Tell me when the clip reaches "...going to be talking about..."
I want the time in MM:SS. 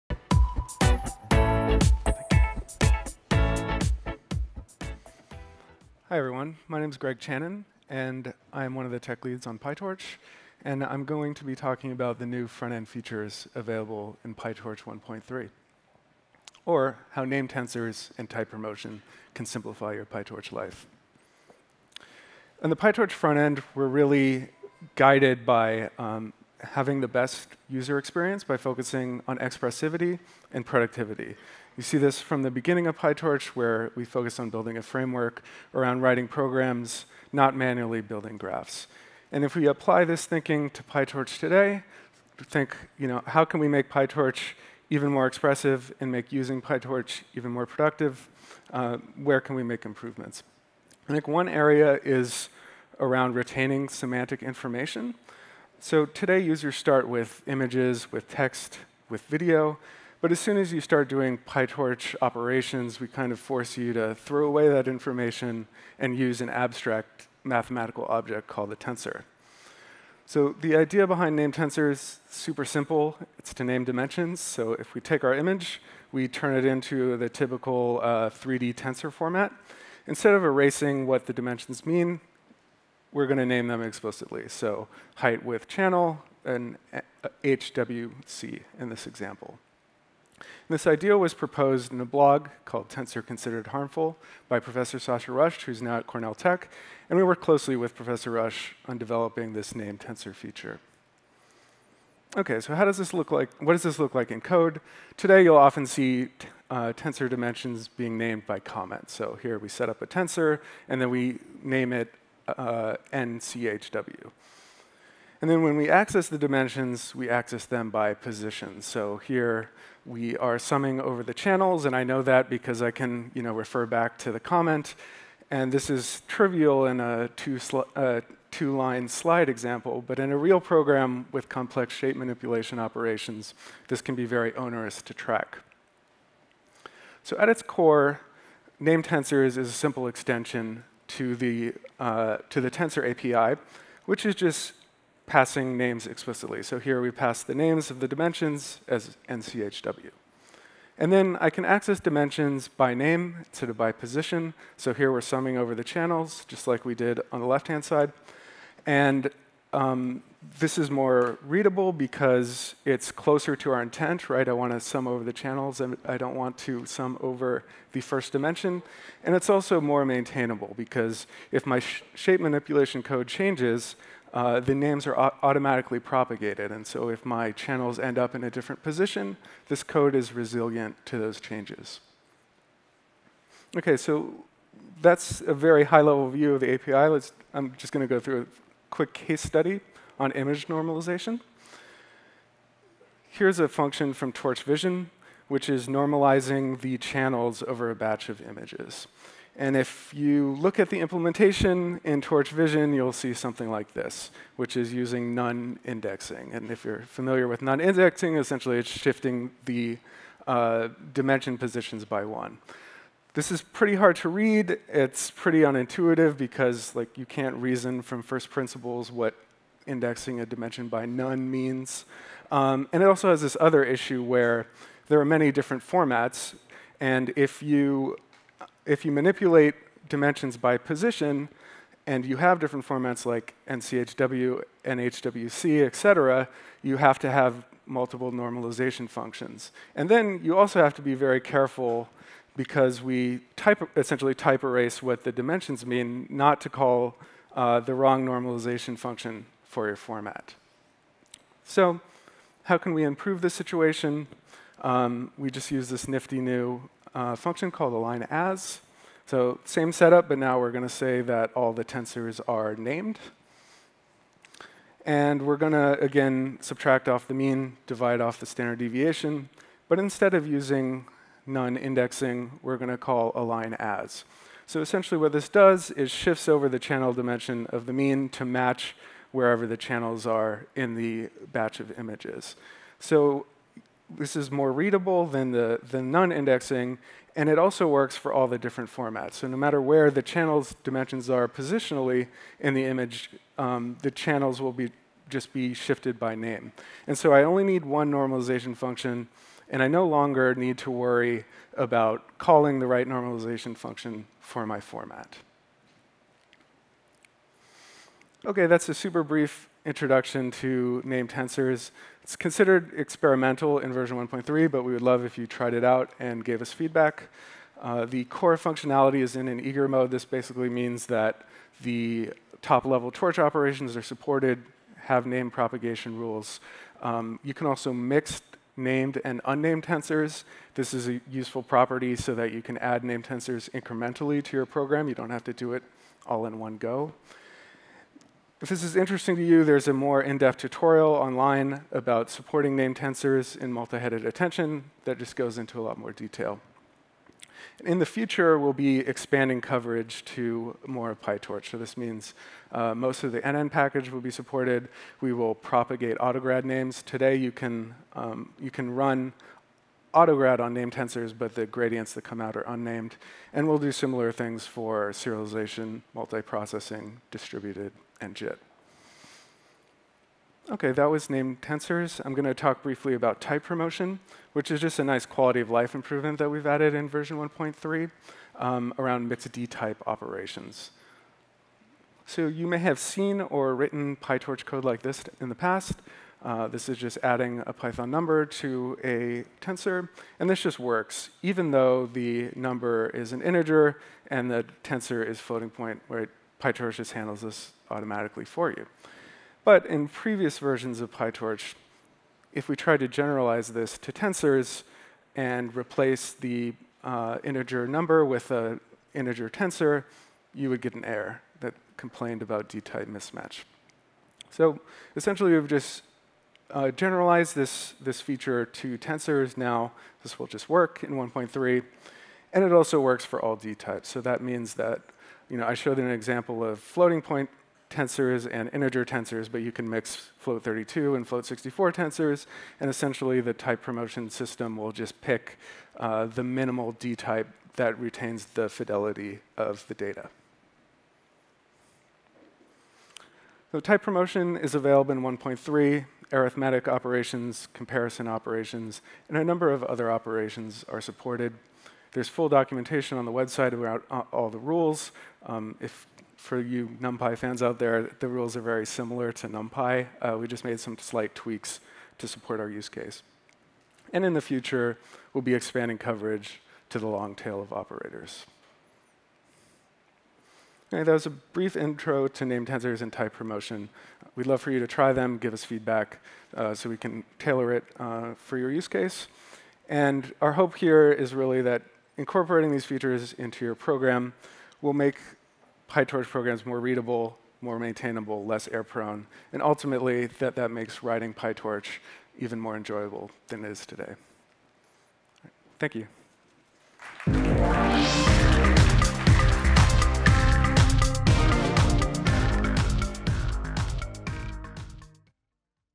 00:11.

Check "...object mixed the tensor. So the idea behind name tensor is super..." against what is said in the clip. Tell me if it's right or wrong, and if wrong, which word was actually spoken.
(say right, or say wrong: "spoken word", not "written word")
wrong: "called", not "mixed".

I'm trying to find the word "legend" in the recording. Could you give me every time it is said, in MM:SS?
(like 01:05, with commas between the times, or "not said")
not said.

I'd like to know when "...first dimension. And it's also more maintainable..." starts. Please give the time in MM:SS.
02:48.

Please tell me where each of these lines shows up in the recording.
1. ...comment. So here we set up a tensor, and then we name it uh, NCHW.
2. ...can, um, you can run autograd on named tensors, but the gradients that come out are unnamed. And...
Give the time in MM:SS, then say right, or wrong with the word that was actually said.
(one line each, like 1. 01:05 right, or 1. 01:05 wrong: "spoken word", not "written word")
1. 01:48 right
2. 05:57 right.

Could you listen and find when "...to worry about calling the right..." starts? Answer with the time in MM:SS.
05:00.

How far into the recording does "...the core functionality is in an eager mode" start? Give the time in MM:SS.
05:18.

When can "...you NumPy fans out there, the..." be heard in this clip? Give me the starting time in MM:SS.
07:36.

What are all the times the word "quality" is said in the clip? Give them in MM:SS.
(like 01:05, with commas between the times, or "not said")
06:15.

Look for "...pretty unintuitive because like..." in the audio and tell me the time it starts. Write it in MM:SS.
03:35.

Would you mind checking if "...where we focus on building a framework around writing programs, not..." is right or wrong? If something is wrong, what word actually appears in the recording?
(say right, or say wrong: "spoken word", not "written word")
right.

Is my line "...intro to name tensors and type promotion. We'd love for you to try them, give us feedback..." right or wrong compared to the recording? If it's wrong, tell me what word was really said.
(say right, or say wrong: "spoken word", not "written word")
right.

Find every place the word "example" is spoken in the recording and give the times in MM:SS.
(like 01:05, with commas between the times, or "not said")
01:29, 02:09, 07:06.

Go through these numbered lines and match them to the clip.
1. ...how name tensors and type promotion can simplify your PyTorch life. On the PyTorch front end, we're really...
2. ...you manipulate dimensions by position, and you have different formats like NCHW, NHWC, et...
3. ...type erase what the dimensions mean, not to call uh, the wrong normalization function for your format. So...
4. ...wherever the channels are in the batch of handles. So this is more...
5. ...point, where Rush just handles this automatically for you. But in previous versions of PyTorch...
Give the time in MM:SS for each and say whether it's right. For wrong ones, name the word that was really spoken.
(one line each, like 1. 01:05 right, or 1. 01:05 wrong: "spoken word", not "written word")
1. 00:17 right
2. 03:49 right
3. 04:04 right
4. 04:39 wrong: "images", not "handles"
5. 06:35 wrong: "PyTorch", not "Rush".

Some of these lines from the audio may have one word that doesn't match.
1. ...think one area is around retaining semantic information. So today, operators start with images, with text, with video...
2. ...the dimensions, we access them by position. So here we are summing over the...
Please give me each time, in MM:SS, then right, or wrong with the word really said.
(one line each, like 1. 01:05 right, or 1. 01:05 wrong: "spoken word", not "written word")
1. 00:51 wrong: "users", not "operators"
2. 01:56 right.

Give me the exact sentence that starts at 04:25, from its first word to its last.
And we're going to, again, subtract off the mean, divide off the standard deviation.